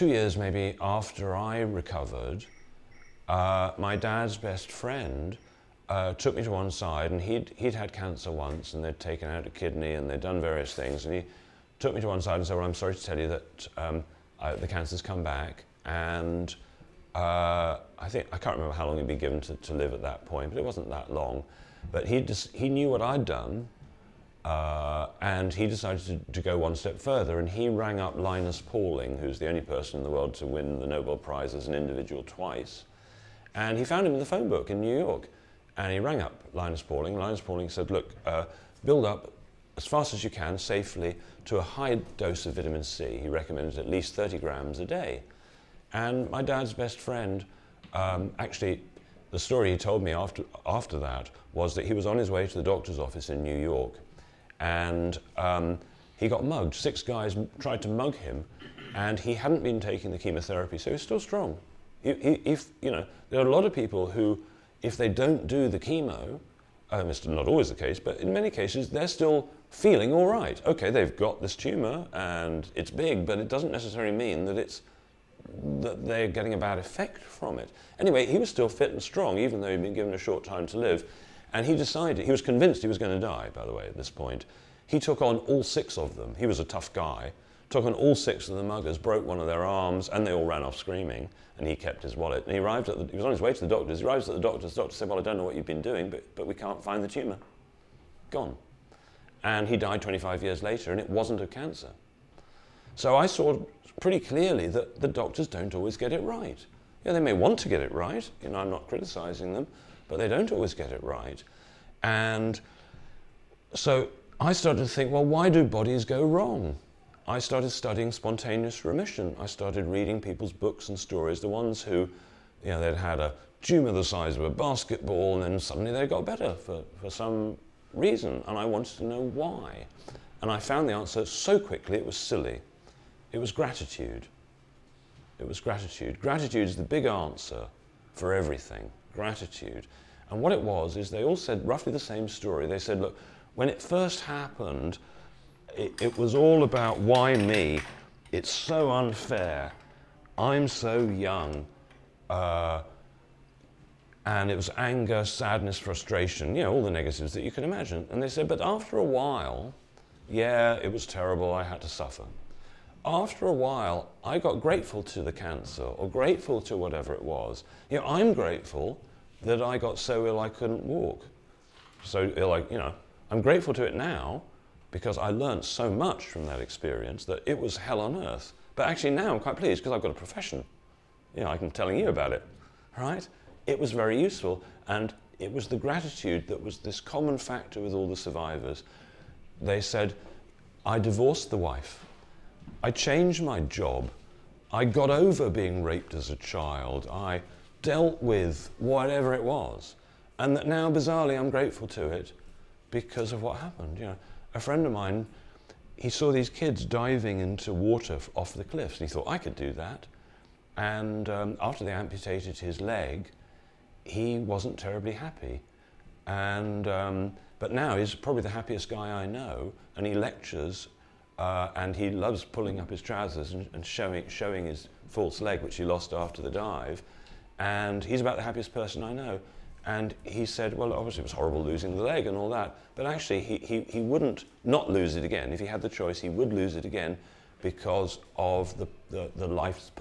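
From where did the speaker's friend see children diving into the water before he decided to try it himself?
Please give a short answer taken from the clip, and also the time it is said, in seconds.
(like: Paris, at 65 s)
Cliffs, at 208 s.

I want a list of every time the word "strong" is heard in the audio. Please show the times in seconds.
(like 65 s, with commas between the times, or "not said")
61 s, 79 s.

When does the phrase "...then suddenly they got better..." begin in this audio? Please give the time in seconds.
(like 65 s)
125 s.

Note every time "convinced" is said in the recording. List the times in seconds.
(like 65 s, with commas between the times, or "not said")
82 s.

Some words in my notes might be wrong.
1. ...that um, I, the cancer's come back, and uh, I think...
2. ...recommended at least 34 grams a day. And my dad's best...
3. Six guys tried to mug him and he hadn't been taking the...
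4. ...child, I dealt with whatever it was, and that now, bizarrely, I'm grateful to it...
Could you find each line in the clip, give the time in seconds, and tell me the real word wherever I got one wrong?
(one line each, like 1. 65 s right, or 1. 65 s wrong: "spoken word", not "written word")
1. 13 s right
2. 43 s wrong: "30", not "34"
3. 56 s right
4. 196 s right.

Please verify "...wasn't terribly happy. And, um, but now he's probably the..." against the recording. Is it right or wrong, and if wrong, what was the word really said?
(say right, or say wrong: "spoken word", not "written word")
right.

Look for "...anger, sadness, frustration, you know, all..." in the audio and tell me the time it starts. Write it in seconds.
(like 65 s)
154 s.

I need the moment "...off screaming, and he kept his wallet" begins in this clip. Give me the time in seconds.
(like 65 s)
90 s.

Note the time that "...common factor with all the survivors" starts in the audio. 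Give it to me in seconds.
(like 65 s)
186 s.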